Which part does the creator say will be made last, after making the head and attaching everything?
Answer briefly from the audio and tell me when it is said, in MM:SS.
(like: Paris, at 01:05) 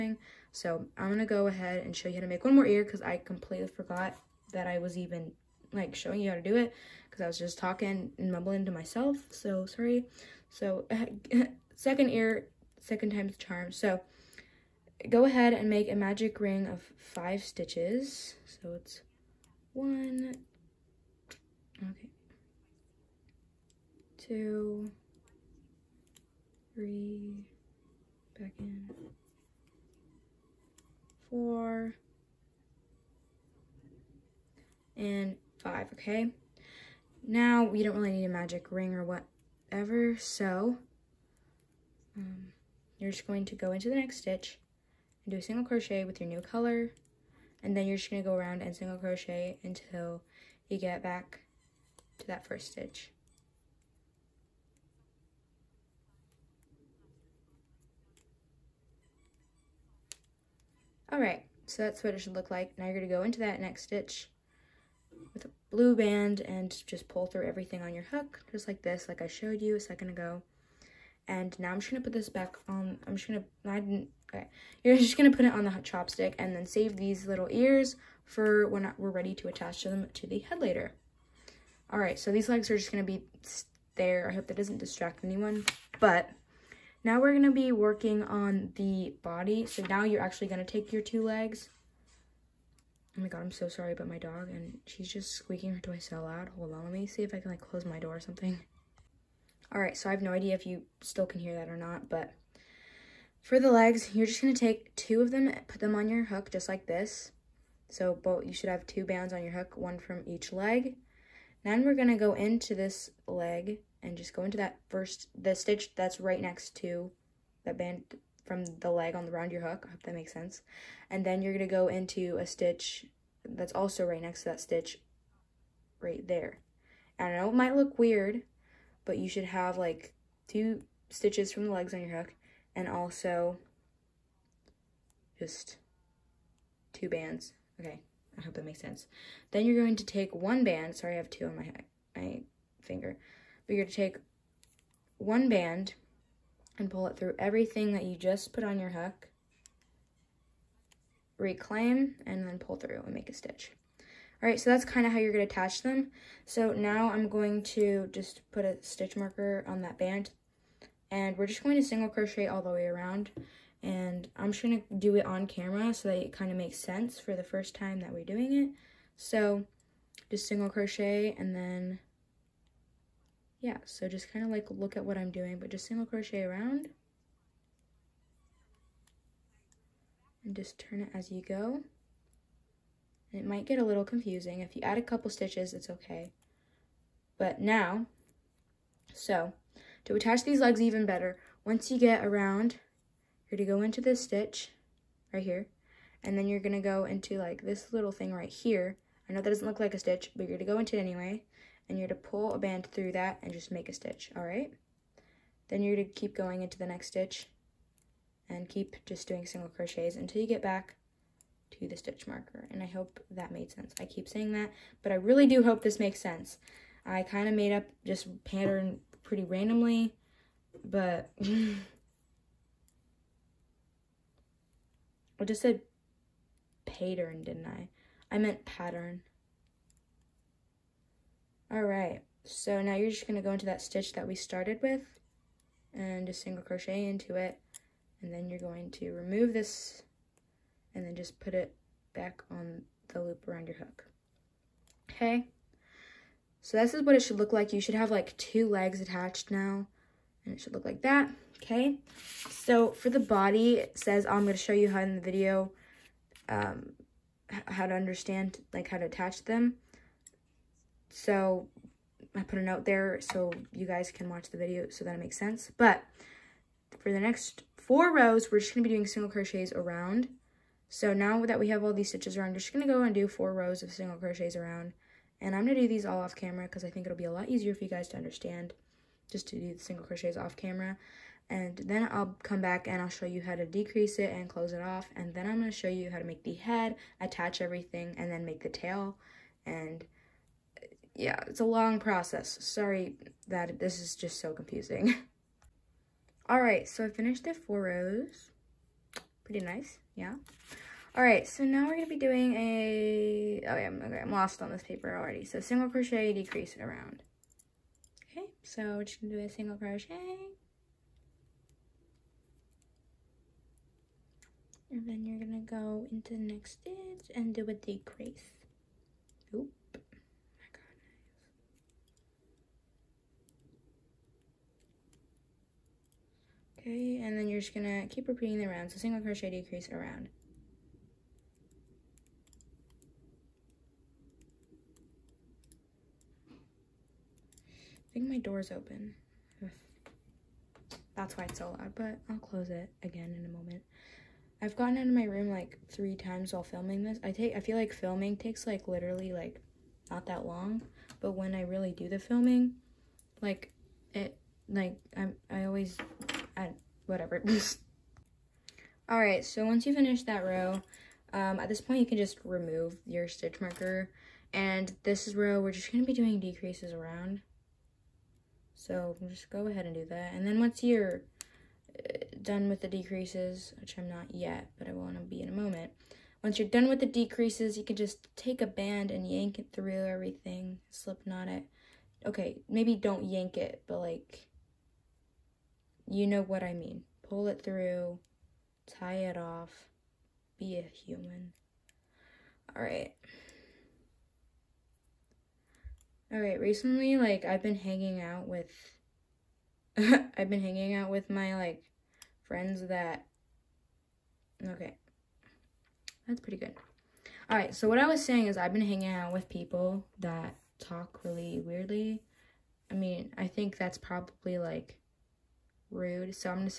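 tail, at 04:48.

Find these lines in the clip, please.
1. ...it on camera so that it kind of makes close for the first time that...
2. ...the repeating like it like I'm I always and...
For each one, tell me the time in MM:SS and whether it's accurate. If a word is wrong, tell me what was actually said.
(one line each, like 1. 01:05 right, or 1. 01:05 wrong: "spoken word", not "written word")
1. 02:45 wrong: "sense", not "close"
2. 05:52 wrong: "filming", not "repeating".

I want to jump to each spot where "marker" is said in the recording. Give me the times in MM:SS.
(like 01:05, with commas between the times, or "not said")
02:39, 03:32, 06:03.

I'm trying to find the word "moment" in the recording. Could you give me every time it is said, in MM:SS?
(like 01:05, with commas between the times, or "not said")
05:43, 06:15.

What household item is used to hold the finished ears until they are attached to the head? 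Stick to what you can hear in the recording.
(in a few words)
chopstick.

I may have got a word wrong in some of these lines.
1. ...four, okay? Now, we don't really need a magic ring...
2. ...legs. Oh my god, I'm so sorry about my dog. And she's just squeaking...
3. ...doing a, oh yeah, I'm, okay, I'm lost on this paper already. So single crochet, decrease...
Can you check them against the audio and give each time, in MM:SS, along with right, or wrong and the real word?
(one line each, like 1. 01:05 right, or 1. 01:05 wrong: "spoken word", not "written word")
1. 00:35 wrong: "five", not "four"
2. 01:31 right
3. 05:02 right.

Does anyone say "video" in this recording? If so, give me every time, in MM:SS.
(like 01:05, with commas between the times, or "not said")
04:15, 04:24.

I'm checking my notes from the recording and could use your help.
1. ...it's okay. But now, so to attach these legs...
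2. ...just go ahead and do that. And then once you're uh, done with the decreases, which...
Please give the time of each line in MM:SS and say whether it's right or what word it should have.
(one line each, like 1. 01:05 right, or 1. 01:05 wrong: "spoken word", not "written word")
1. 03:05 right
2. 06:09 right.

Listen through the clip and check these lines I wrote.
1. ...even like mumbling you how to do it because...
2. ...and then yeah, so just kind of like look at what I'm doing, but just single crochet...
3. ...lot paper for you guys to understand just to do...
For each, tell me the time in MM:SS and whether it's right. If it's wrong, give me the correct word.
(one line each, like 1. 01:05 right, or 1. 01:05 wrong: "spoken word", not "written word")
1. 00:04 wrong: "showing", not "mumbling"
2. 02:51 right
3. 04:37 wrong: "easier", not "paper".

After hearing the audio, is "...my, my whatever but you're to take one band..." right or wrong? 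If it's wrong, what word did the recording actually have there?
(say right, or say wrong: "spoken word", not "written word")
wrong: "finger", not "whatever".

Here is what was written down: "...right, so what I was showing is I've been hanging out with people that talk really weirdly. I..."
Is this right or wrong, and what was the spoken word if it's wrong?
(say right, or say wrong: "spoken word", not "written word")
wrong: "saying", not "showing".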